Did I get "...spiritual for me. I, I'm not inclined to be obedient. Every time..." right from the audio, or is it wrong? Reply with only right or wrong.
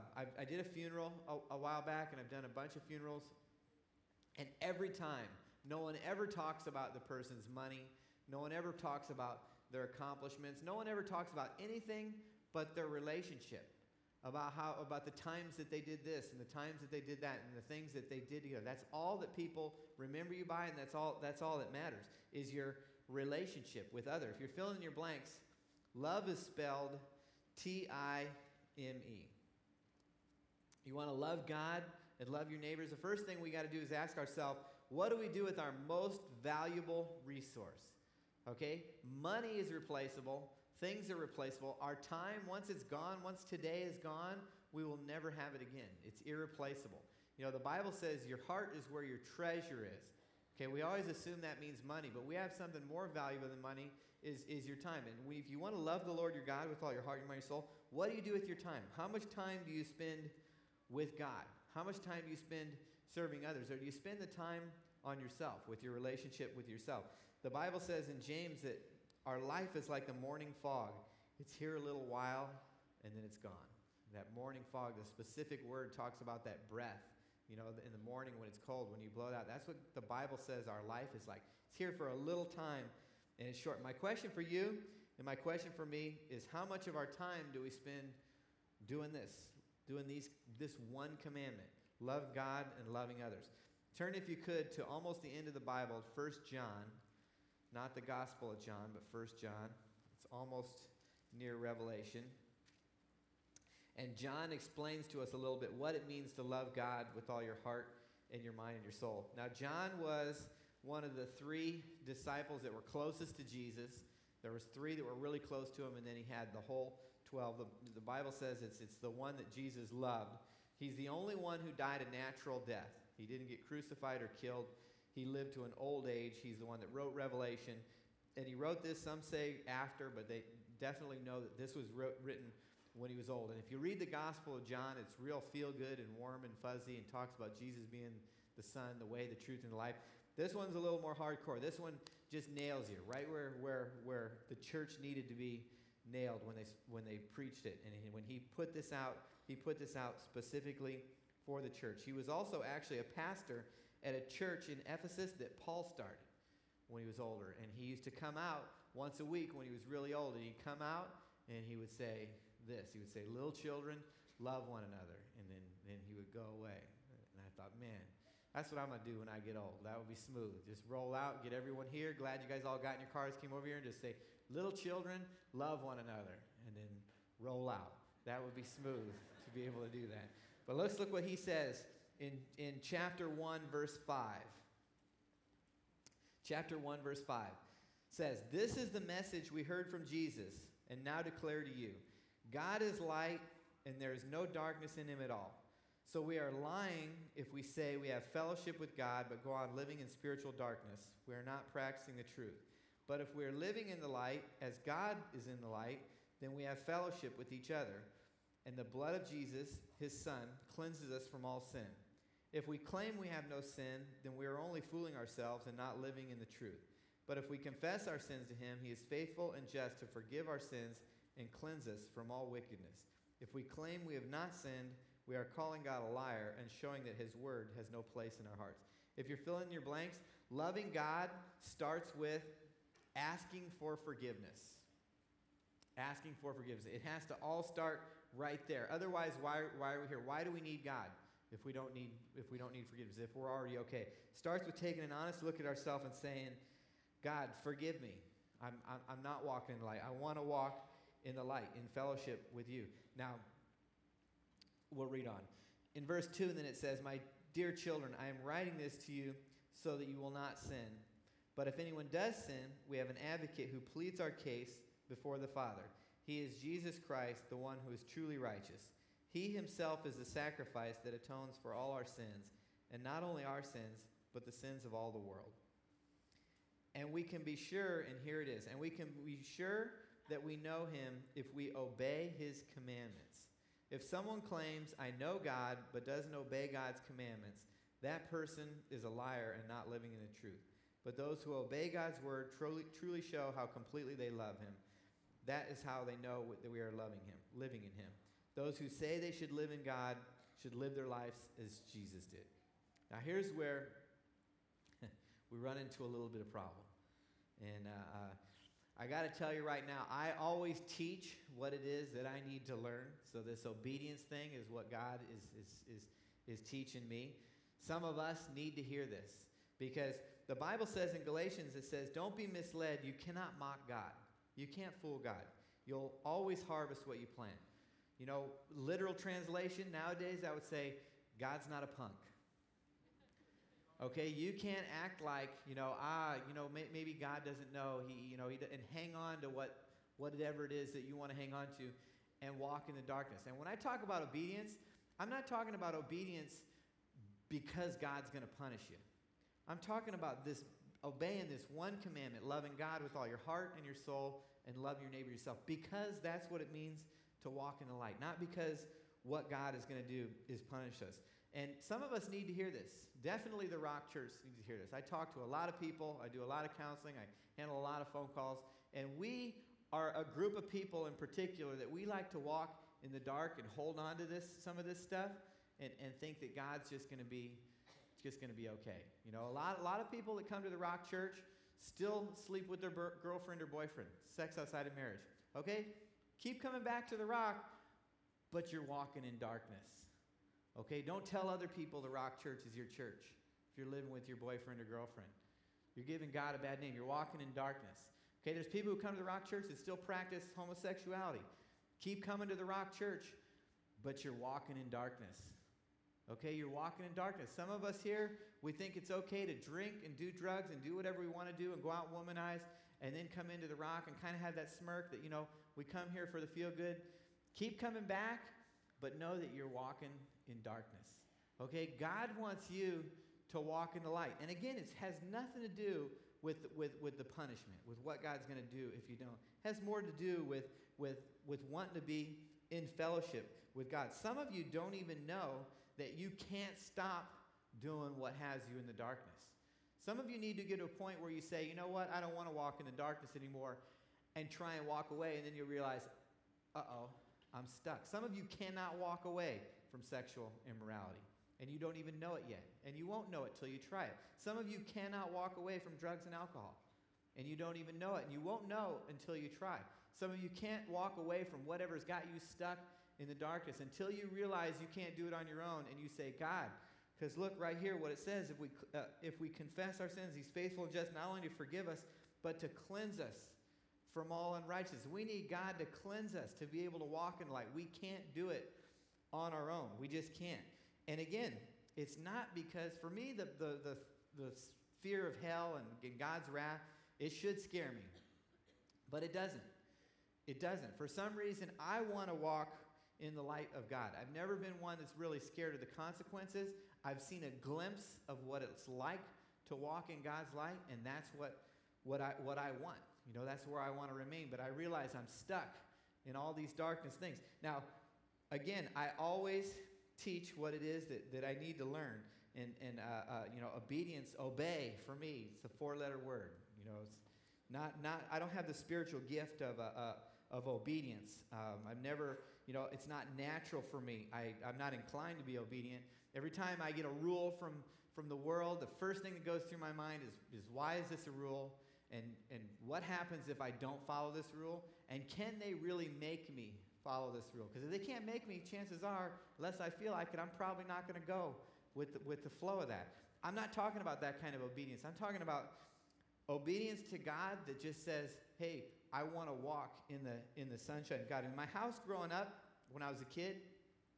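wrong.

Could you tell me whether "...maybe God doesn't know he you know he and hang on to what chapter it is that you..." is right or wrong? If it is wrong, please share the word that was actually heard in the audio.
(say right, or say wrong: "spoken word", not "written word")
wrong: "whatever", not "chapter".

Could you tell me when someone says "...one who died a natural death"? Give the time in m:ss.
2:01.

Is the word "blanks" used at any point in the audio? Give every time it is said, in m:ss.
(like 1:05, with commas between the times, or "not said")
0:24, 3:49.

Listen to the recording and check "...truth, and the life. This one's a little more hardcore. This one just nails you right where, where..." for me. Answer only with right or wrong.
right.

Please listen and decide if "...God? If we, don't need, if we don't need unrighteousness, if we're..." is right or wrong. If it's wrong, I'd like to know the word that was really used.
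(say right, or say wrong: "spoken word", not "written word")
wrong: "forgiveness", not "unrighteousness".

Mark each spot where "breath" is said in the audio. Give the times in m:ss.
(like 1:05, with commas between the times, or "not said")
1:16.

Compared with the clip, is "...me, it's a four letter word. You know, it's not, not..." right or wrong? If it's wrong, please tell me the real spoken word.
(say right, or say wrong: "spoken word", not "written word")
right.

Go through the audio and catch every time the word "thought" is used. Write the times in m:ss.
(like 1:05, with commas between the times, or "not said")
2:47.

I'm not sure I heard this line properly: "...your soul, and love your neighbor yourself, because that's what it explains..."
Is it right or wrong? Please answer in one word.
wrong.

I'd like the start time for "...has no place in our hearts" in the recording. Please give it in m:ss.
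3:47.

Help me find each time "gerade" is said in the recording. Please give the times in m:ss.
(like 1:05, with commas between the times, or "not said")
not said.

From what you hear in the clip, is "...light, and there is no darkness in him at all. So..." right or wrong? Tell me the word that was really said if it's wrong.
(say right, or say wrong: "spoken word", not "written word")
right.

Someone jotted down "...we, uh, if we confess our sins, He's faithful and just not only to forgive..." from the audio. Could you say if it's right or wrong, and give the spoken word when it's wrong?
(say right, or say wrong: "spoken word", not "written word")
right.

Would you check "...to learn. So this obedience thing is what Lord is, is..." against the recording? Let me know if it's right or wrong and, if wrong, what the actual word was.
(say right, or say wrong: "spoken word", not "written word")
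wrong: "God", not "Lord".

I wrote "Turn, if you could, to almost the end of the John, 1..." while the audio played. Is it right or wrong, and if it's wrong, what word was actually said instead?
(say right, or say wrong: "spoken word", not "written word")
wrong: "Bible", not "John".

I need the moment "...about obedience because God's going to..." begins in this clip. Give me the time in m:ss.
5:45.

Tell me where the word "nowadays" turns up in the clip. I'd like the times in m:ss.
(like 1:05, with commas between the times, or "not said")
5:29.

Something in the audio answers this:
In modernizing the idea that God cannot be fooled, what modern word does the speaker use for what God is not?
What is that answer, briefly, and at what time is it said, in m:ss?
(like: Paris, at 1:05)
A punk, at 5:31.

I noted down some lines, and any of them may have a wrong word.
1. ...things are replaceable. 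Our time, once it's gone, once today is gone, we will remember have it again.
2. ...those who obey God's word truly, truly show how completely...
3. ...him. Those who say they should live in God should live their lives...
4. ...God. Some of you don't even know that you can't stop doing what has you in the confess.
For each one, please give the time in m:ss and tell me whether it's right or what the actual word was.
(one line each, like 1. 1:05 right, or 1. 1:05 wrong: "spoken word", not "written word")
1. 0:40 wrong: "never", not "remember"
2. 4:51 right
3. 4:57 right
4. 7:13 wrong: "darkness", not "confess".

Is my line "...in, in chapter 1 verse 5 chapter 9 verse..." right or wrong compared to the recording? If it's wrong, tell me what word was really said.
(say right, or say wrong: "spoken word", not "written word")
wrong: "1", not "9".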